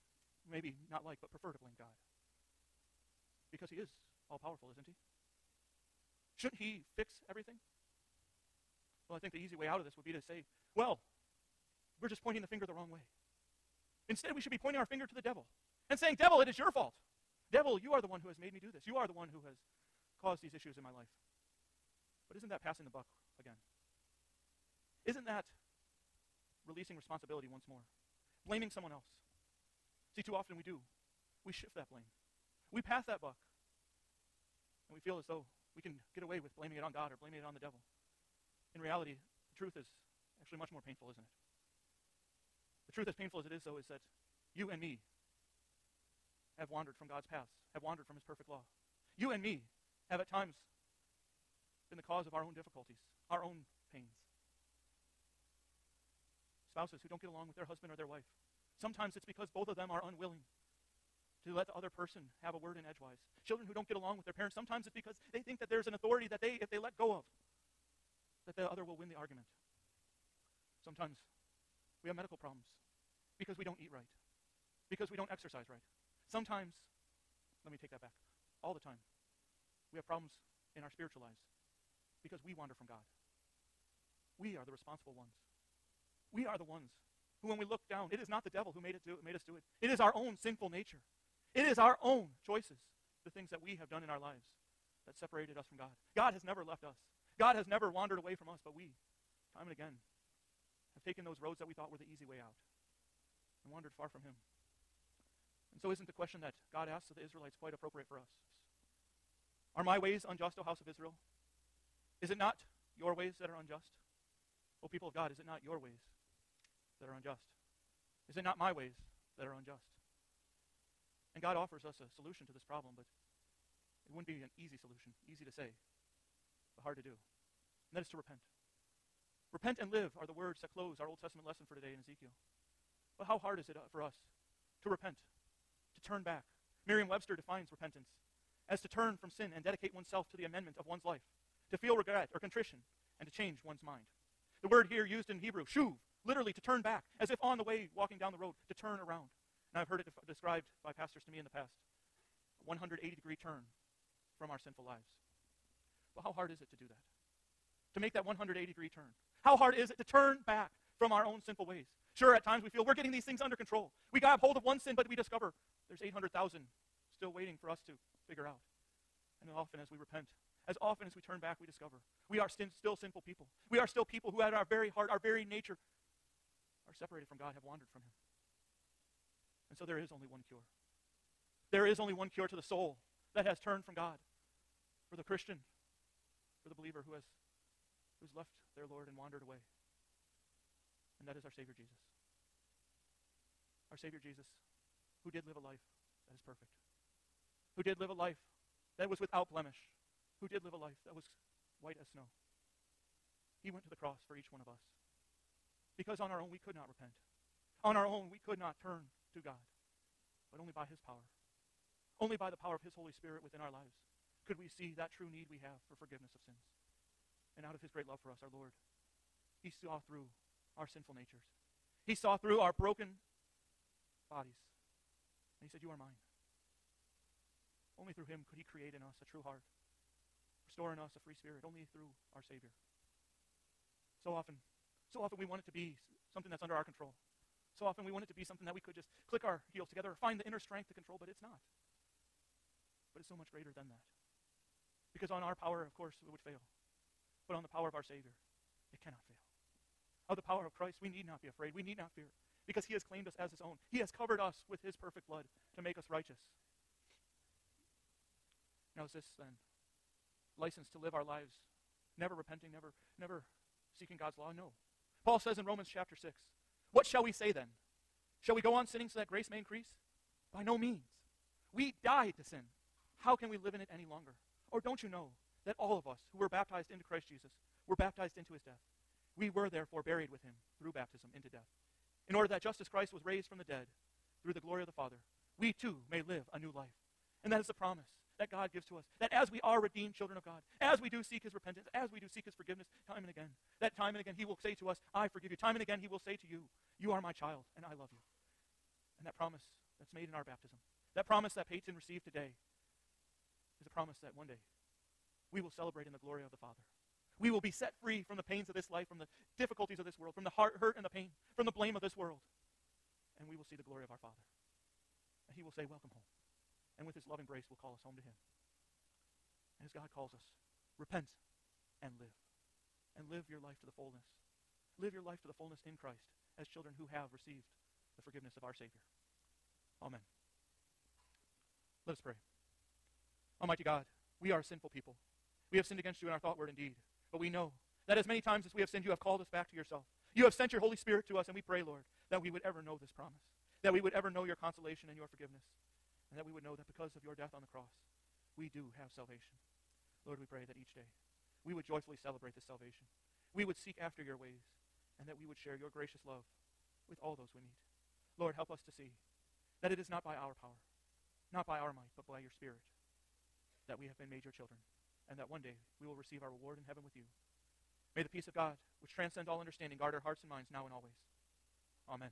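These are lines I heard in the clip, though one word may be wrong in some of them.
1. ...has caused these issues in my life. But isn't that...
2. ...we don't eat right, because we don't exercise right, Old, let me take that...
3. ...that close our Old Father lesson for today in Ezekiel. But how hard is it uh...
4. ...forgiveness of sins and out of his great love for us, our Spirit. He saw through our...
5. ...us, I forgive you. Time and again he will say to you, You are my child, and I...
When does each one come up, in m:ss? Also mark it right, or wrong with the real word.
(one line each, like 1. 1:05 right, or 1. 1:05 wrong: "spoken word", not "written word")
1. 0:19 right
2. 1:13 wrong: "Sometimes", not "Old"
3. 2:10 wrong: "Testament", not "Father"
4. 3:35 wrong: "Lord", not "Spirit"
5. 4:54 right.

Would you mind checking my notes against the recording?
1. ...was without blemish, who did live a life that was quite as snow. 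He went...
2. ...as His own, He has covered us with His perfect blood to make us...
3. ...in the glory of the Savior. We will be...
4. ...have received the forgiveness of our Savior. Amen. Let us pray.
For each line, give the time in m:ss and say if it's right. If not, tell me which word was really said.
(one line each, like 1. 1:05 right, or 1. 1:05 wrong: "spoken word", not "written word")
1. 3:19 wrong: "white", not "quite"
2. 4:13 right
3. 5:06 wrong: "Father", not "Savior"
4. 5:27 right.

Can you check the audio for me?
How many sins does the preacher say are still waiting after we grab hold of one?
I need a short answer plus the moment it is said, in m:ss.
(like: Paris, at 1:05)
800,000, at 2:46.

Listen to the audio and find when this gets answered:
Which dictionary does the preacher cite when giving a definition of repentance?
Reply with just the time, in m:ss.
2:16.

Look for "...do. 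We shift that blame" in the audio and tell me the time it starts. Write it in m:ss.
0:30.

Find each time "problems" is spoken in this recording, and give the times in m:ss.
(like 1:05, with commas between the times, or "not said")
1:12, 1:20, 2:02.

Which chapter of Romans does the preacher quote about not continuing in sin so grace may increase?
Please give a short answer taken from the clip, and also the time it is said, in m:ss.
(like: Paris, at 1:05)
Chapter 6, at 4:25.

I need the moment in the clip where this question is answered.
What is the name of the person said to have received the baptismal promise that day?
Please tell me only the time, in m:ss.
5:01.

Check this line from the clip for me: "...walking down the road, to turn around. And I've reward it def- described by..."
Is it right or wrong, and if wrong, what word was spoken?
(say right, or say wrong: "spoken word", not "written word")
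wrong: "heard", not "reward".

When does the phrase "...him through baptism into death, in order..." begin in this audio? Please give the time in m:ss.
4:40.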